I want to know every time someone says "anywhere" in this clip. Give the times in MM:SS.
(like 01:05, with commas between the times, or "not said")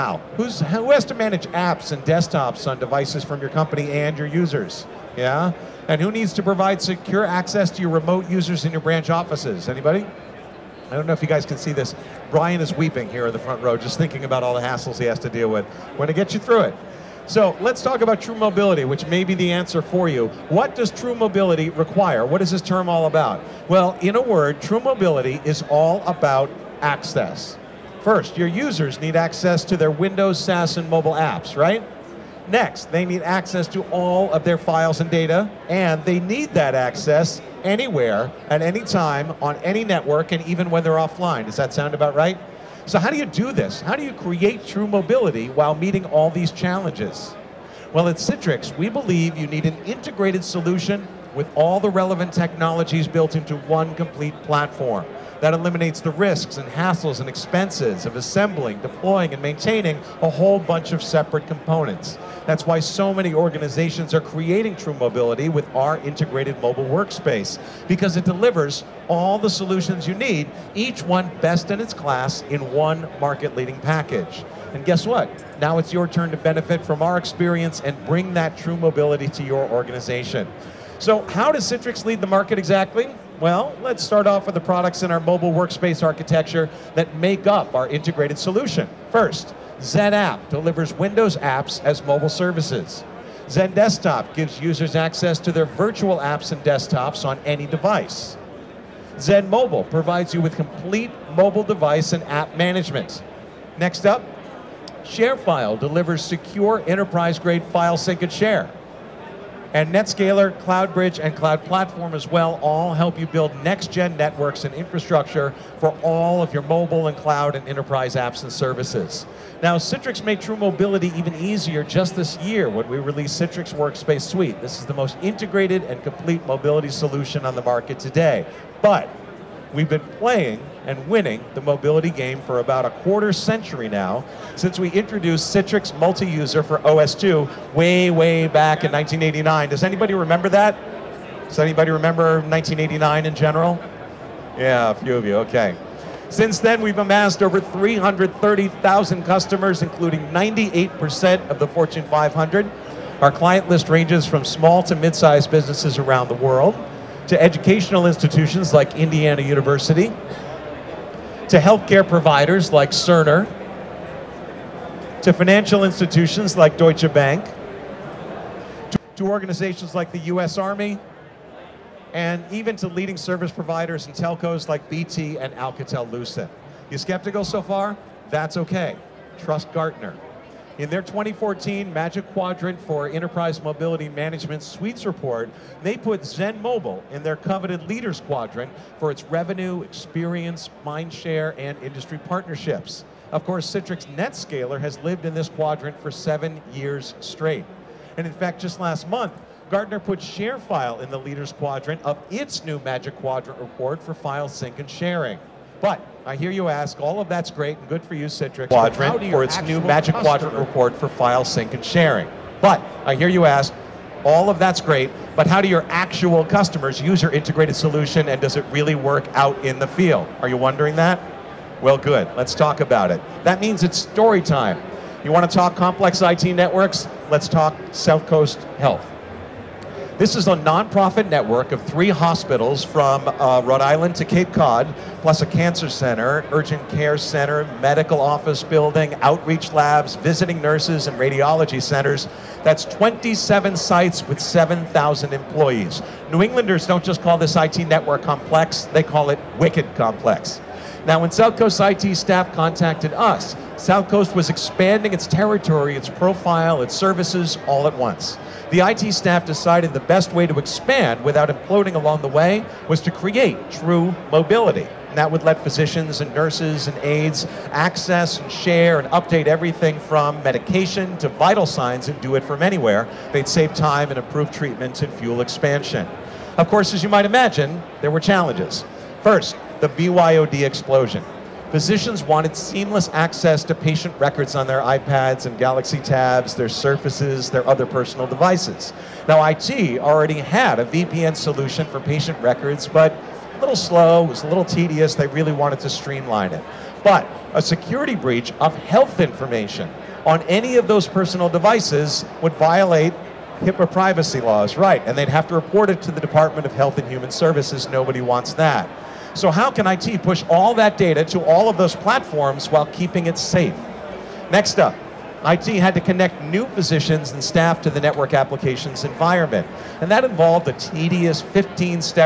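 00:37, 04:32.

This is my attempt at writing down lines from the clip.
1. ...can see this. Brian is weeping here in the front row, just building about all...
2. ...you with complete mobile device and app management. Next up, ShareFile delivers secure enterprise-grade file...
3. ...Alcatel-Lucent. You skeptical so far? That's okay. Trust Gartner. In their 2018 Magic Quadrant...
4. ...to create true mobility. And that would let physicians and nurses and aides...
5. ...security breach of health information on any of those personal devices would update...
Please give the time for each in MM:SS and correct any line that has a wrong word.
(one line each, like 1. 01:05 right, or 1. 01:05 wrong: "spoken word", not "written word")
1. 00:11 wrong: "thinking", not "building"
2. 01:40 right
3. 02:55 wrong: "2014", not "2018"
4. 04:22 right
5. 04:57 wrong: "violate", not "update".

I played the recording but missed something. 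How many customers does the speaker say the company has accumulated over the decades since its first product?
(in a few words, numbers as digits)
330,000.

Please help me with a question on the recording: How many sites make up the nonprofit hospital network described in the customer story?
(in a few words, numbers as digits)
27.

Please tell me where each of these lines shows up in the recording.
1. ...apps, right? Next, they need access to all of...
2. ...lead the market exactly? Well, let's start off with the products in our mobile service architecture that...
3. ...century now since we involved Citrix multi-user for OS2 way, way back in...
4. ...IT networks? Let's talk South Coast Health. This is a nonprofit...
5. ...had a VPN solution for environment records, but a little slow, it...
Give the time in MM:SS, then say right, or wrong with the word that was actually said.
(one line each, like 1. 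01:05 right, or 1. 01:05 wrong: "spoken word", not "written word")
1. 00:31 right
2. 01:22 wrong: "workspace", not "service"
3. 02:13 wrong: "introduced", not "involved"
4. 03:46 right
5. 04:50 wrong: "patient", not "environment".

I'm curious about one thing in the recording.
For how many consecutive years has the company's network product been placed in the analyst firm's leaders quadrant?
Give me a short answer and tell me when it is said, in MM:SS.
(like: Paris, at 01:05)
7, at 03:16.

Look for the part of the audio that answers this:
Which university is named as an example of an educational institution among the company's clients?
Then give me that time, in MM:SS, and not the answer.
02:38.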